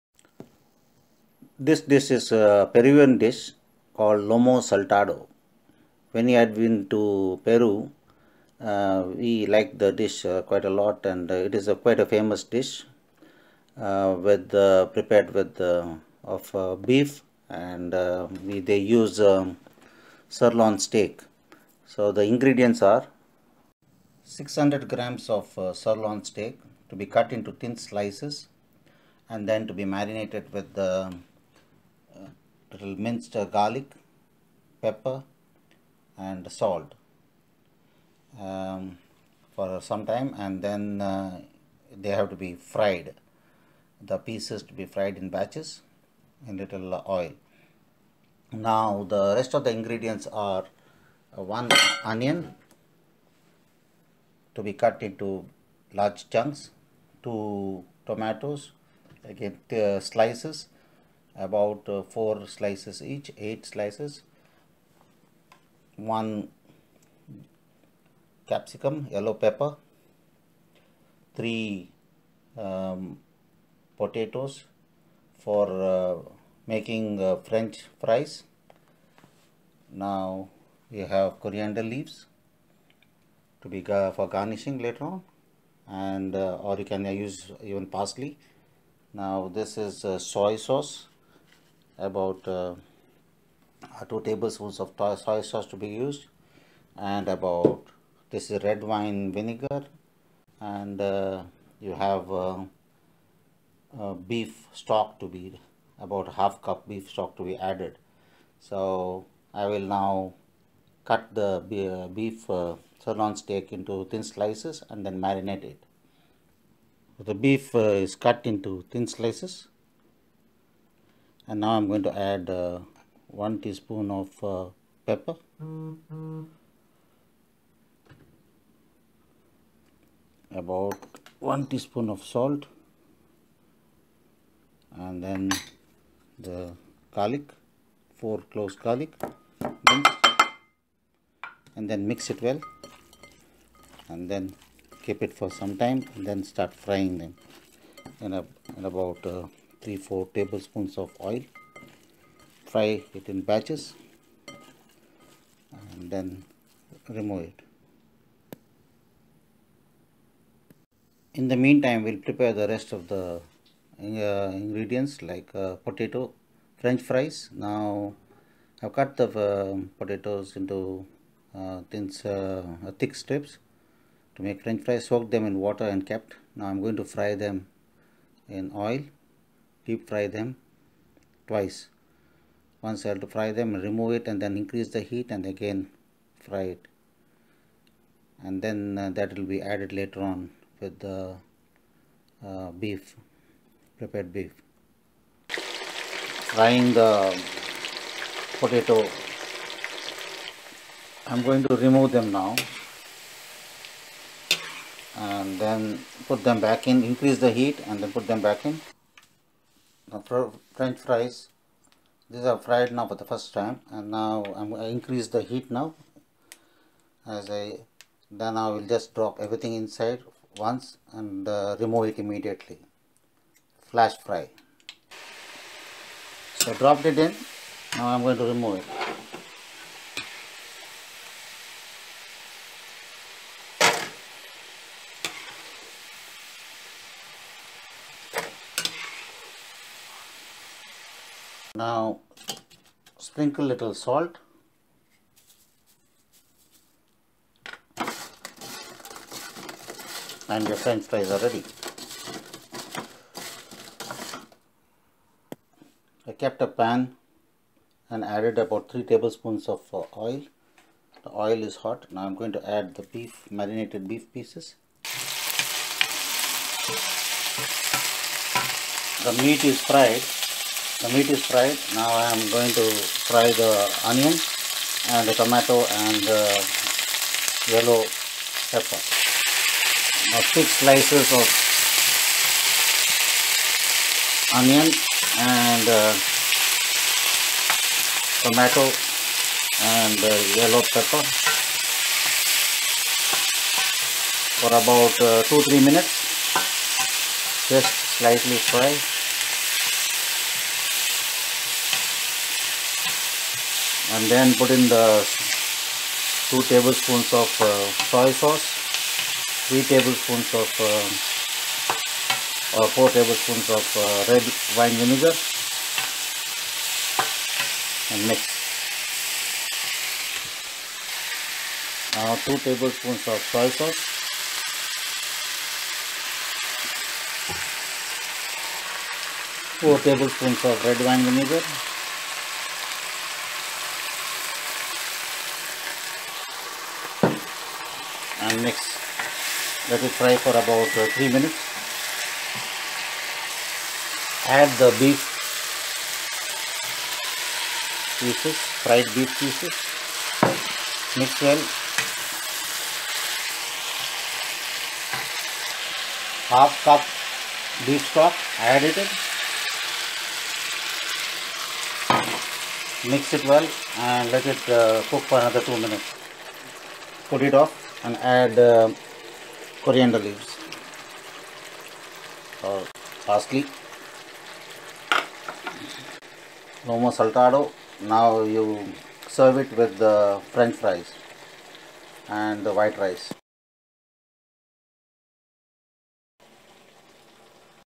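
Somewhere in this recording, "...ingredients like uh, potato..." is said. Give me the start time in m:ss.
2:44.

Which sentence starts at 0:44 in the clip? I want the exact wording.
The pieces to be fried in batches in little oil.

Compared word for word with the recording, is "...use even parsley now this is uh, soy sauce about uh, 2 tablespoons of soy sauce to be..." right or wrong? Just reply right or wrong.
right.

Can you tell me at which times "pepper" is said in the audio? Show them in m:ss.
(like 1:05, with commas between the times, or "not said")
0:34, 1:09, 2:05, 4:38, 4:50.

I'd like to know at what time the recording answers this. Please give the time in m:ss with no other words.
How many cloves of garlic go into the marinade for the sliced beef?
2:18.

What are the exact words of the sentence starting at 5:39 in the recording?
Let it fry for about uh, 3 minutes.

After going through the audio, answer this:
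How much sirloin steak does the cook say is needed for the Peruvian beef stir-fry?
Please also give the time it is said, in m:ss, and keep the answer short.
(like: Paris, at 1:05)
600 grams, at 0:24.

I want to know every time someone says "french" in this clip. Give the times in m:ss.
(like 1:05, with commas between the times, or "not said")
1:17, 2:46, 2:54, 3:30, 4:10, 6:20.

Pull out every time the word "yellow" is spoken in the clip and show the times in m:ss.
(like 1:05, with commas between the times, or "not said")
1:09, 4:37, 4:50.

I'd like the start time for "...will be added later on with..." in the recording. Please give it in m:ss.
3:09.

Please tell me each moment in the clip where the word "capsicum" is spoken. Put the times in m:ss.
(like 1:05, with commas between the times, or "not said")
1:08.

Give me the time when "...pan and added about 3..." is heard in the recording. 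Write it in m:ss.
4:16.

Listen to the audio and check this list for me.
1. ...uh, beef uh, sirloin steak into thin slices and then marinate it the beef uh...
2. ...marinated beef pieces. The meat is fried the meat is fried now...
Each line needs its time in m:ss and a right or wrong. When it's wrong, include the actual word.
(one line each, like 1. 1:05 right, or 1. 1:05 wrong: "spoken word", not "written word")
1. 1:51 right
2. 4:23 right.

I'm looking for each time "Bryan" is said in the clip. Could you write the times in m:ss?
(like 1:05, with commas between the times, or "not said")
not said.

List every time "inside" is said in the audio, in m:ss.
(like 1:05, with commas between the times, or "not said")
3:39.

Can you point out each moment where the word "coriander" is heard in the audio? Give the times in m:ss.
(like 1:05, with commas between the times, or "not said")
1:21, 6:09.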